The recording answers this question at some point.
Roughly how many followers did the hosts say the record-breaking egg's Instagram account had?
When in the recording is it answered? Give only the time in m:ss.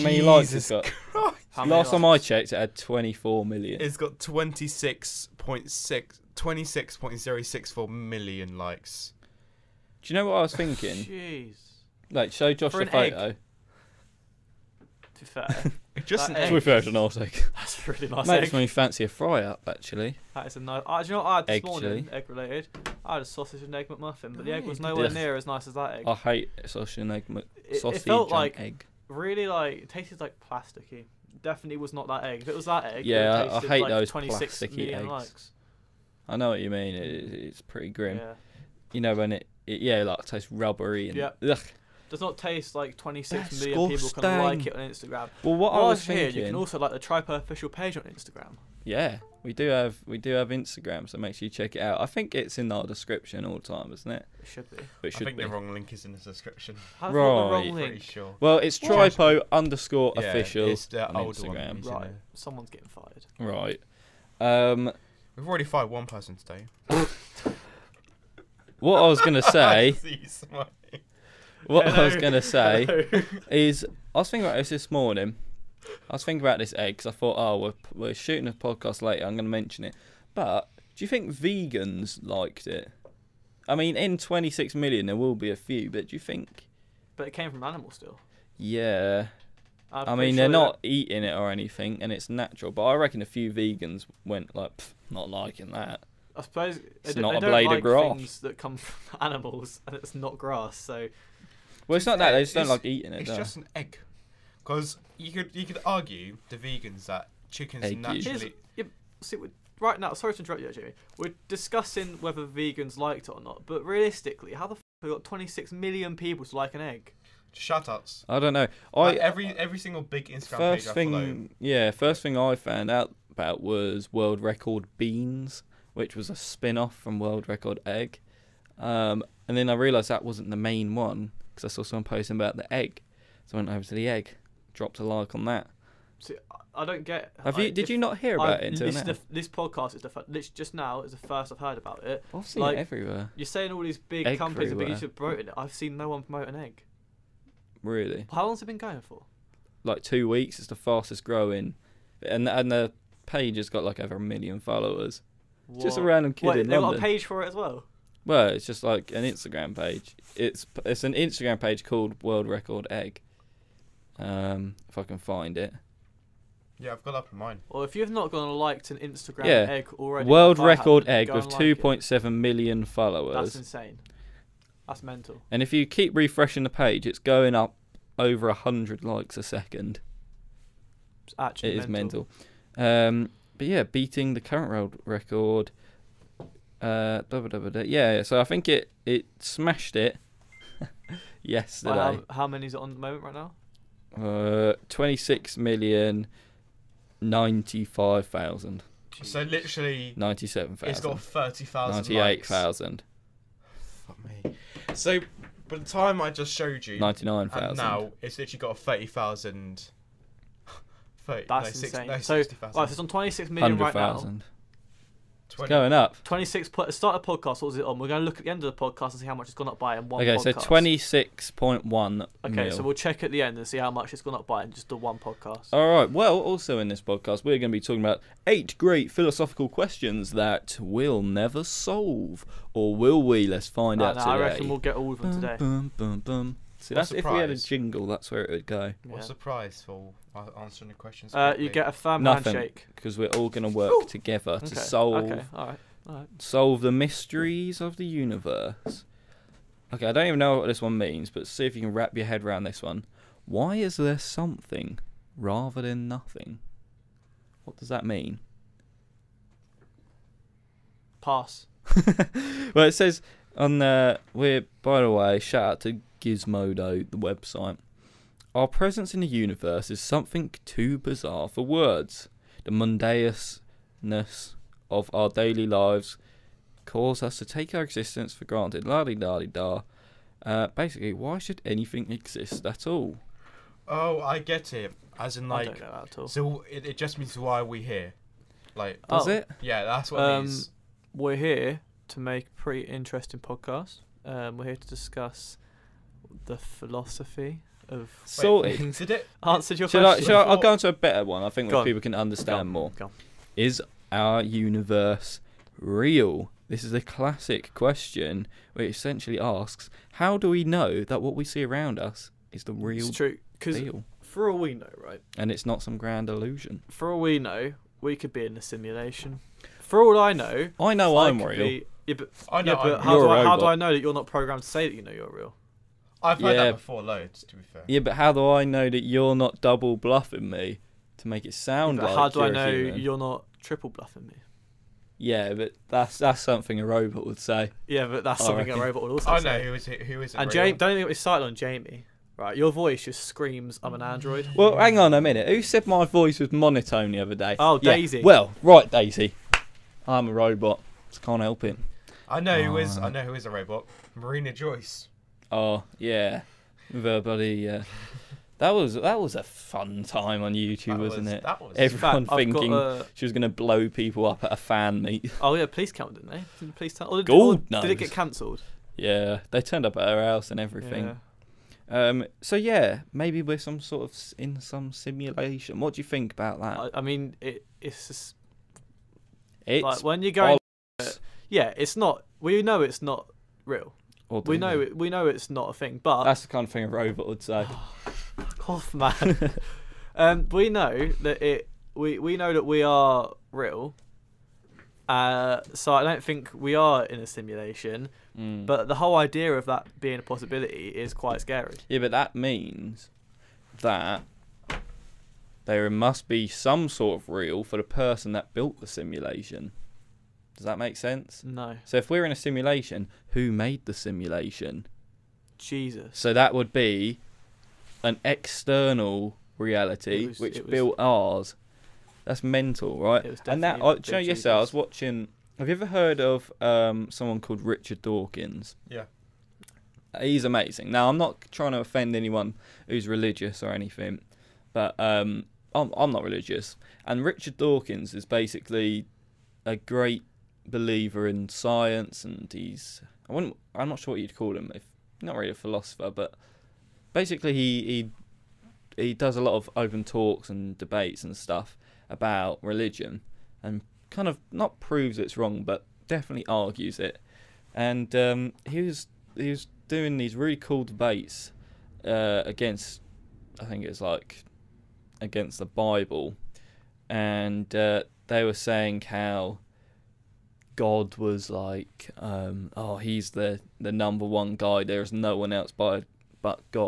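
2:51.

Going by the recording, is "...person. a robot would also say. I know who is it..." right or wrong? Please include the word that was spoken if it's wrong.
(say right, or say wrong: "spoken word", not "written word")
wrong: "reckon", not "person".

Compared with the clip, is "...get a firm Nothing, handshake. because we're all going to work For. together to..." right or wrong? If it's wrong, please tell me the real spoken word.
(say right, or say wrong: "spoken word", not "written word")
wrong: "Ooh", not "For".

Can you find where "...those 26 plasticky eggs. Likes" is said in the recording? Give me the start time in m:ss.
0:33.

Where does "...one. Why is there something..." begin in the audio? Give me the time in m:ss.
4:12.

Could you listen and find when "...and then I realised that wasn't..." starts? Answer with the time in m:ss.
2:09.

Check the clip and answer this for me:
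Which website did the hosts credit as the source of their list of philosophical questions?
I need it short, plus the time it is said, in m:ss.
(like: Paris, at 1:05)
Gizmodo, at 4:26.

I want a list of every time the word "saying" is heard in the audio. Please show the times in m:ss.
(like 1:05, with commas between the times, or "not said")
2:23, 7:48.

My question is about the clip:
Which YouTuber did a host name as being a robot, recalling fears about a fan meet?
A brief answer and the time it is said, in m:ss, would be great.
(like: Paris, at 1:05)
Marina Joyce, at 5:54.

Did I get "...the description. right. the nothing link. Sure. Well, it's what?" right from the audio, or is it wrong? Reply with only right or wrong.
wrong.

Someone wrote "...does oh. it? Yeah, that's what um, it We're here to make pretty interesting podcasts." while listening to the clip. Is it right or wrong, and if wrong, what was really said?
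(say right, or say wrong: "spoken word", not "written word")
right.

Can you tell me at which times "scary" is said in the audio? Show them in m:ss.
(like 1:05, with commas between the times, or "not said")
6:41.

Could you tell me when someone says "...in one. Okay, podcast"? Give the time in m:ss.
3:39.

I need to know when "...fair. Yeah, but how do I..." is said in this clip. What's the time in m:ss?
5:27.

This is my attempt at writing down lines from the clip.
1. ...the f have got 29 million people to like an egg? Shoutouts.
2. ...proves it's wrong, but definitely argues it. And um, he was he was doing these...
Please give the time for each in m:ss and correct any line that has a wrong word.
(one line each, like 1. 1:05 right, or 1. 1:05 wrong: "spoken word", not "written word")
1. 1:54 wrong: "26", not "29"
2. 7:34 right.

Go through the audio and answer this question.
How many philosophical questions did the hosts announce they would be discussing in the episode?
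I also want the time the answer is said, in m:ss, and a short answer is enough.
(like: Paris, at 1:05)
8, at 3:48.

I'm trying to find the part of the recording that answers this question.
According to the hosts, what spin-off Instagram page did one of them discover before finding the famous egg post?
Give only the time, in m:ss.
2:04.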